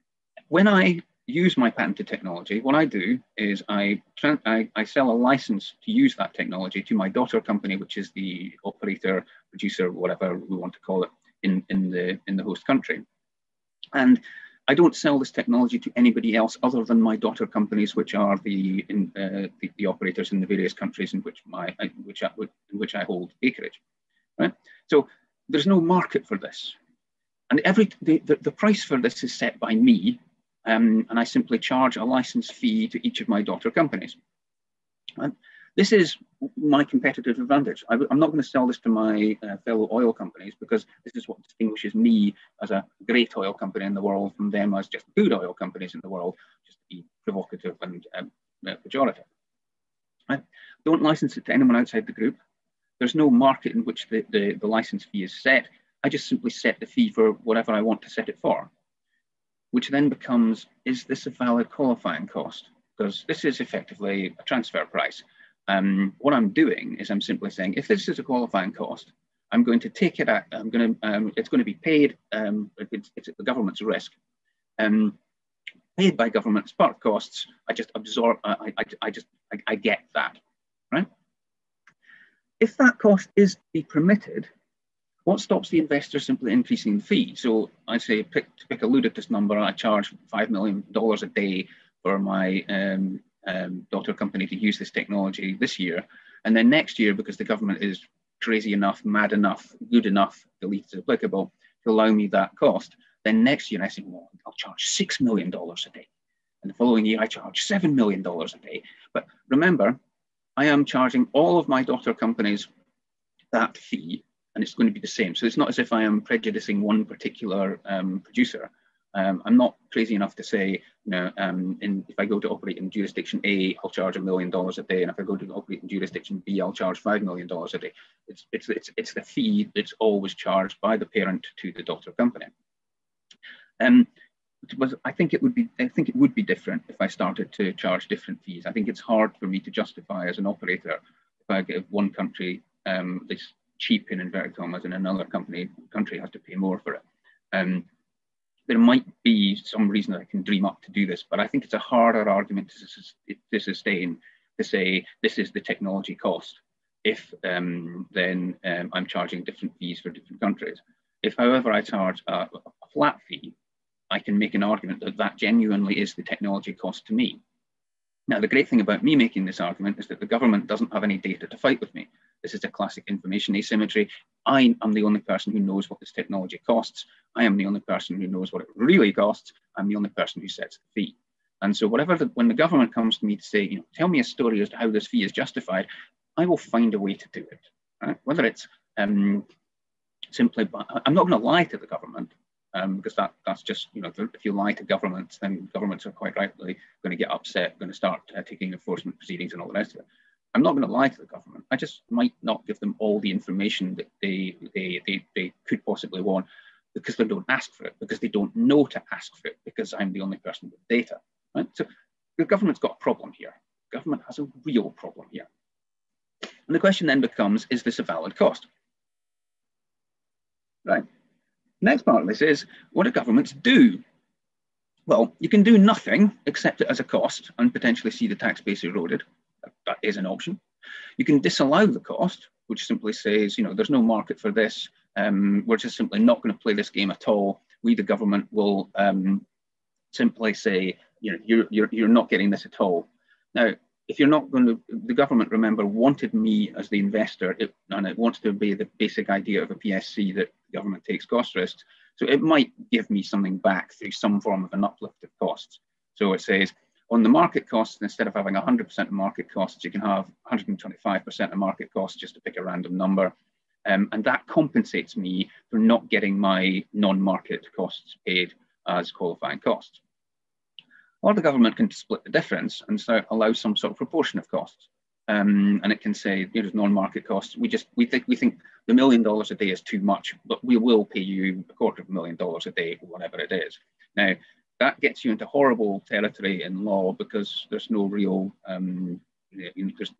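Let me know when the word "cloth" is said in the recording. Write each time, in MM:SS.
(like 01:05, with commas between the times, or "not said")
not said.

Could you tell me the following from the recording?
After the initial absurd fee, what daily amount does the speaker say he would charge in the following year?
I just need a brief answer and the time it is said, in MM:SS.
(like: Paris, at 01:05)
$6 million, at 01:44.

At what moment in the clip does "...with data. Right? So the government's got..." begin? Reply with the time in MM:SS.
03:30.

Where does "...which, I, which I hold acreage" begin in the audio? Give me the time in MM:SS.
00:22.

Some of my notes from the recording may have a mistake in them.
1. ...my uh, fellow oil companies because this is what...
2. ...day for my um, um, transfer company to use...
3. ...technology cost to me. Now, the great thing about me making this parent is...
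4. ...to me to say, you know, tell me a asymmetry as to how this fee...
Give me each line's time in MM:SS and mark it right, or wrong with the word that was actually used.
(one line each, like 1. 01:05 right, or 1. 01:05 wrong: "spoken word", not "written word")
1. 00:38 right
2. 01:31 wrong: "daughter", not "transfer"
3. 02:46 wrong: "argument", not "parent"
4. 03:03 wrong: "story", not "asymmetry".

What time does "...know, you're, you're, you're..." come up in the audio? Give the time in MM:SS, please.
04:01.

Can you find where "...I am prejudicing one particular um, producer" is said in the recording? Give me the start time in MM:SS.
01:55.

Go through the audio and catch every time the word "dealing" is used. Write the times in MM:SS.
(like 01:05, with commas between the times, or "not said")
not said.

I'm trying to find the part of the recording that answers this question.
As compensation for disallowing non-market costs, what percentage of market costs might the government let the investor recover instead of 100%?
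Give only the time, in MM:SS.
04:20.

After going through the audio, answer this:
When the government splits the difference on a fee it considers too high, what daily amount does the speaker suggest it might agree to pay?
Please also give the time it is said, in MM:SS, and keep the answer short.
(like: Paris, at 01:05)
$250,000, at 04:41.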